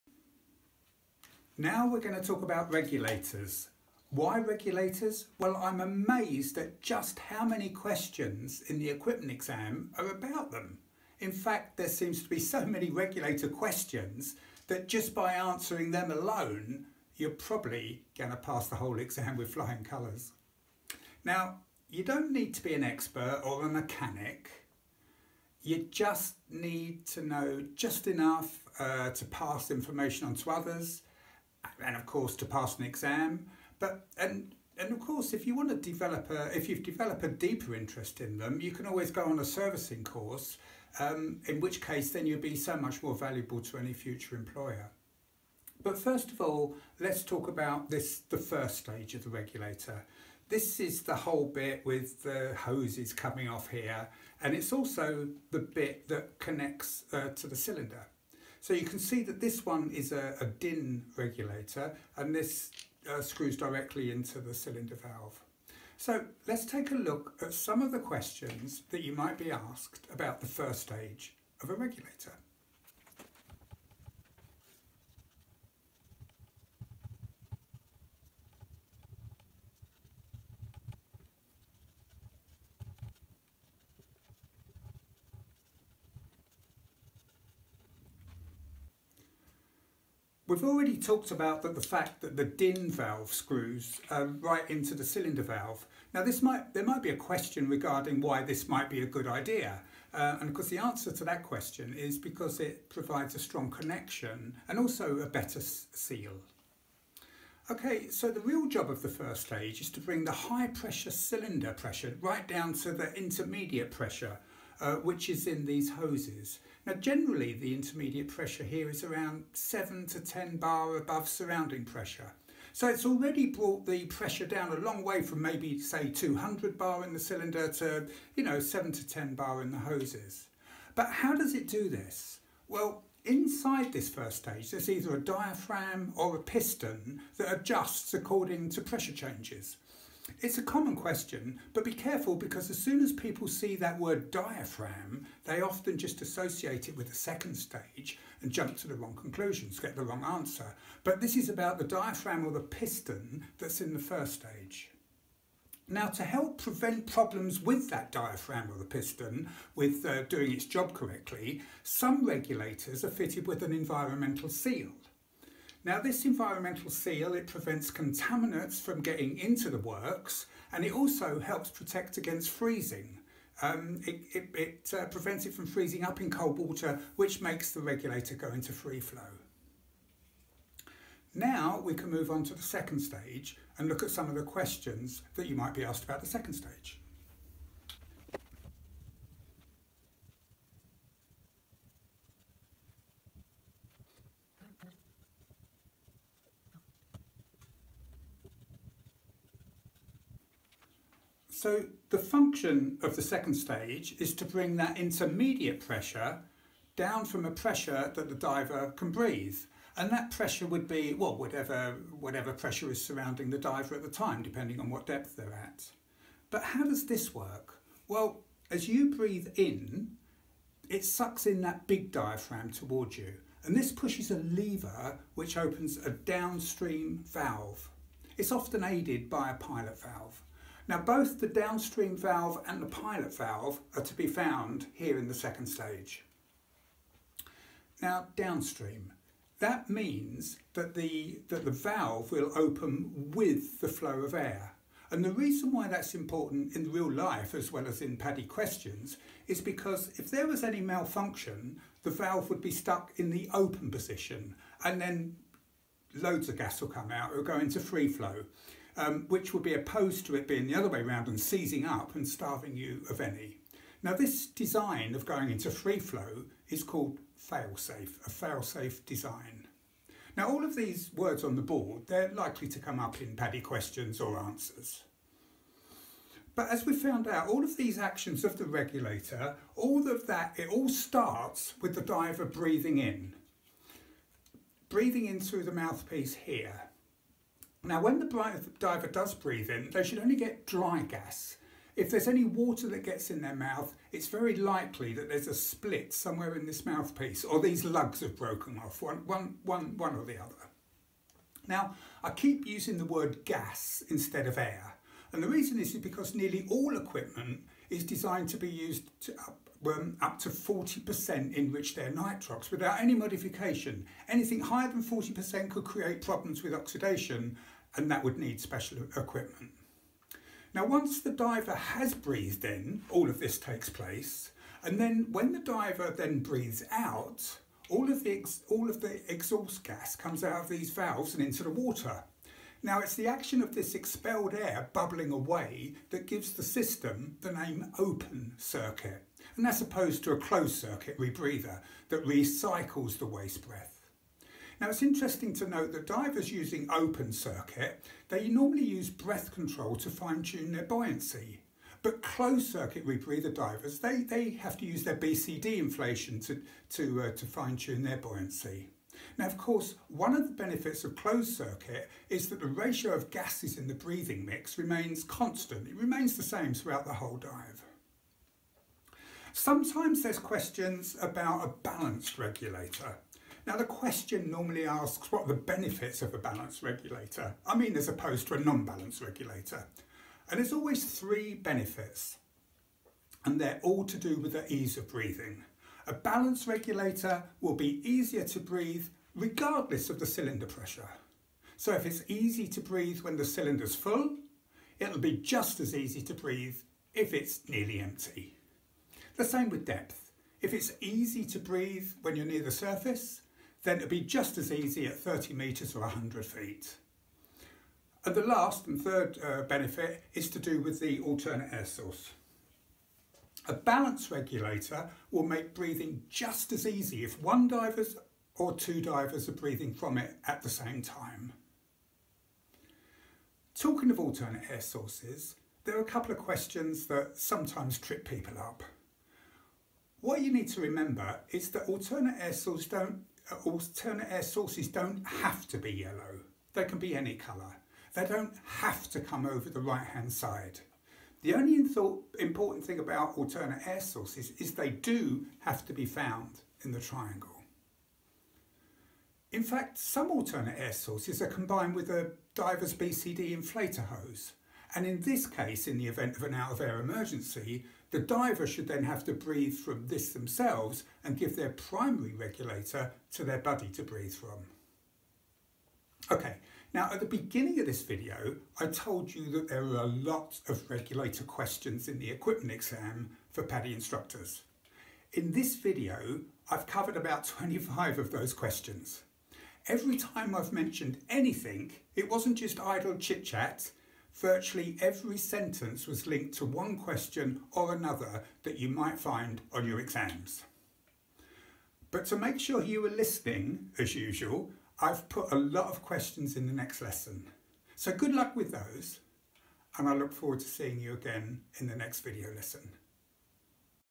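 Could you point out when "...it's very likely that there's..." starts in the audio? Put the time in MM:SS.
04:54.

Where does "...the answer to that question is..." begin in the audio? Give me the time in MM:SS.
01:40.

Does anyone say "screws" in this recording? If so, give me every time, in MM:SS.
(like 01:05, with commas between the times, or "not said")
01:03, 01:33.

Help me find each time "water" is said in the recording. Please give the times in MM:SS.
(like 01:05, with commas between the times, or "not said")
02:56, 04:52, 05:31.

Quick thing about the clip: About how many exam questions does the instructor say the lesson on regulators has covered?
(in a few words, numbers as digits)
25.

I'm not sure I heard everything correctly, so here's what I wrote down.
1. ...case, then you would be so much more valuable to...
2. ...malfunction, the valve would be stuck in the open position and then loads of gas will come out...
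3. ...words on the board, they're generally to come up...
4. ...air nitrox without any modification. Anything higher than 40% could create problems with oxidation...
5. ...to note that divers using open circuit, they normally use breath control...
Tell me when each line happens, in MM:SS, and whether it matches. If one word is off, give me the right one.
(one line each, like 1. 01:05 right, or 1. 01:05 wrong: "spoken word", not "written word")
1. 00:41 right
2. 04:10 right
3. 04:31 wrong: "likely", not "generally"
4. 05:11 right
5. 05:45 right.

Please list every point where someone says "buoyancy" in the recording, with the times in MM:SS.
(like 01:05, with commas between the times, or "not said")
05:50, 05:58.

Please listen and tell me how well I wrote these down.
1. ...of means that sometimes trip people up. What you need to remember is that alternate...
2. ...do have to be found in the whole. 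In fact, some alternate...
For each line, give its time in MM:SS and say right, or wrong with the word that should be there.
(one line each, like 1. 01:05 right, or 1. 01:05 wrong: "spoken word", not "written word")
1. 07:06 wrong: "questions", not "means"
2. 07:24 wrong: "triangle", not "whole".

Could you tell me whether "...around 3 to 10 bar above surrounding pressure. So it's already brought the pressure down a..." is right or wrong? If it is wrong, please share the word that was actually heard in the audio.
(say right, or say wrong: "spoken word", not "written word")
wrong: "7", not "3".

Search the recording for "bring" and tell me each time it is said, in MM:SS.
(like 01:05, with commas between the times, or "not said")
01:50, 03:24.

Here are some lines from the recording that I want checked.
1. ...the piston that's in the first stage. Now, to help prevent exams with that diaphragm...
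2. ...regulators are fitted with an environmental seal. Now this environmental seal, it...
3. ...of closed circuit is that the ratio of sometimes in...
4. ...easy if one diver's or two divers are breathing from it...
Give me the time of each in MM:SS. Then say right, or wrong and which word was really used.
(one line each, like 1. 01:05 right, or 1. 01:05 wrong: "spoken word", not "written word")
1. 02:32 wrong: "problems", not "exams"
2. 02:42 right
3. 06:01 wrong: "gases", not "sometimes"
4. 06:56 right.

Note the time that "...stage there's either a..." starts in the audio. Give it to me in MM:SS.
02:14.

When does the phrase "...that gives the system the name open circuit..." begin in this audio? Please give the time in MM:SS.
05:36.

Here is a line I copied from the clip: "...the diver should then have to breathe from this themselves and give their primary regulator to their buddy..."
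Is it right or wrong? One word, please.
right.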